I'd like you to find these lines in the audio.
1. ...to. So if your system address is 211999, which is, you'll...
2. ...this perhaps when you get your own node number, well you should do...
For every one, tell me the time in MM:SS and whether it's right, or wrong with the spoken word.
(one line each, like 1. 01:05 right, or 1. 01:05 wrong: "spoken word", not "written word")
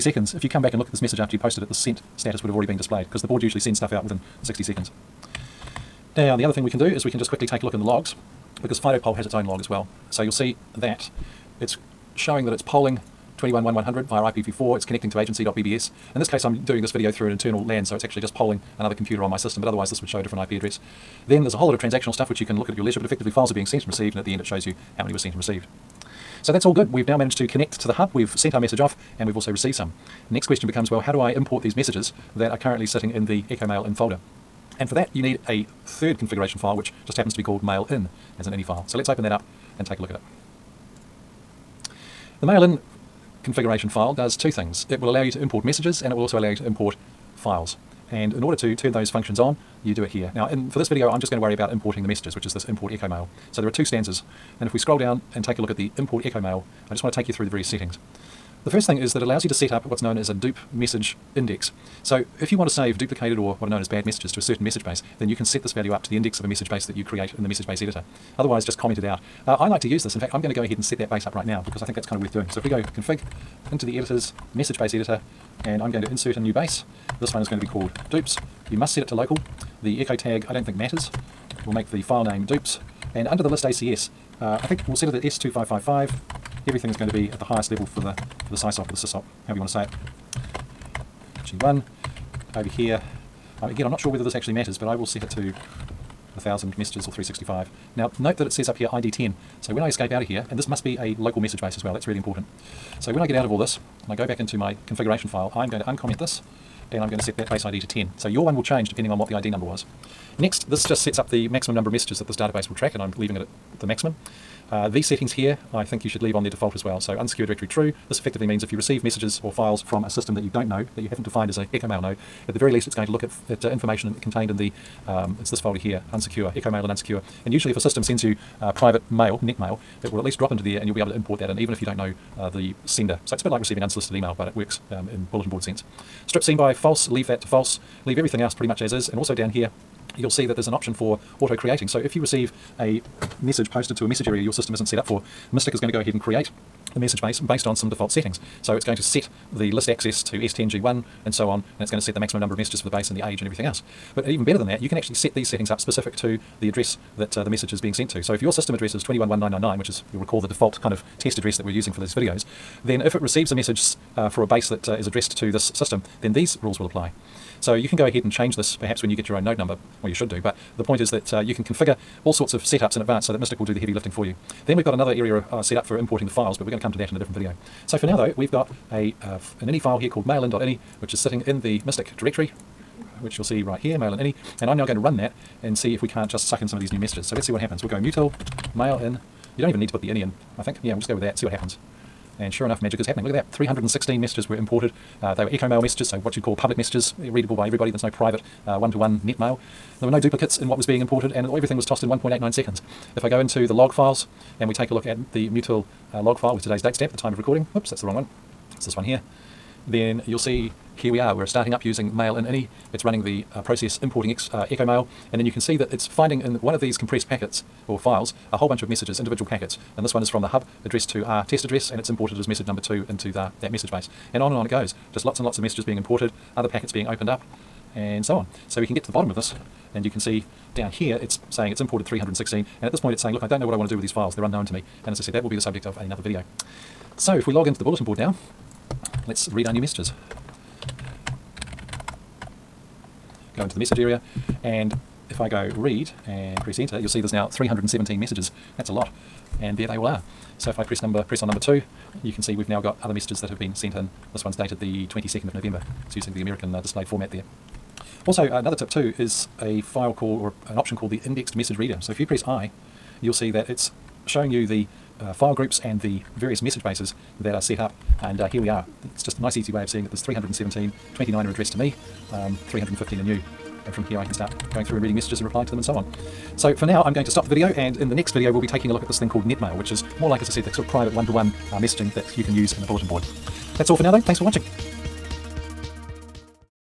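1. 02:38 right
2. 02:48 right.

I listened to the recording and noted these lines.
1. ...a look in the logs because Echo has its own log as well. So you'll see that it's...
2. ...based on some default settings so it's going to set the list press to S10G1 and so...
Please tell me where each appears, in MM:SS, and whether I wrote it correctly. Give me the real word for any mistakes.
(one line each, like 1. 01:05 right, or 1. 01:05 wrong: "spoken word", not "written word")
1. 00:07 wrong: "FidoPoll", not "Echo"
2. 02:27 wrong: "access", not "press".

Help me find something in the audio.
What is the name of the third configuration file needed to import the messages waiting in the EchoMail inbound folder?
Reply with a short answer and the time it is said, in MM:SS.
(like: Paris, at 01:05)
mailin.ini, at 00:37.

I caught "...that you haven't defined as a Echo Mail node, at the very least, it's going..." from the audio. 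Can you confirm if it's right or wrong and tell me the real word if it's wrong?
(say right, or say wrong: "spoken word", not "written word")
right.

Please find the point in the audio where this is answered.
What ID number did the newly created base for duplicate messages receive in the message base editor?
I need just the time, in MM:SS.
01:38.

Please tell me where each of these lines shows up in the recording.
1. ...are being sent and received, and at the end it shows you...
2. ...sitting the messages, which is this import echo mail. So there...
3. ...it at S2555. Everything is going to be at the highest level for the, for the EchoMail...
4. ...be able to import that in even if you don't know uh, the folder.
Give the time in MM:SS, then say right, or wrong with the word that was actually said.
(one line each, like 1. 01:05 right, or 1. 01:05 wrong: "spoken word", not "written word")
1. 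00:23 right
2. 00:51 wrong: "importing", not "sitting"
3. 01:25 wrong: "SysOp", not "EchoMail"
4. 02:10 wrong: "sender", not "folder".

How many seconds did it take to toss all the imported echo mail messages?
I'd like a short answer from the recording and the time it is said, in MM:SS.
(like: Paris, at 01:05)
1.89 seconds, at 03:22.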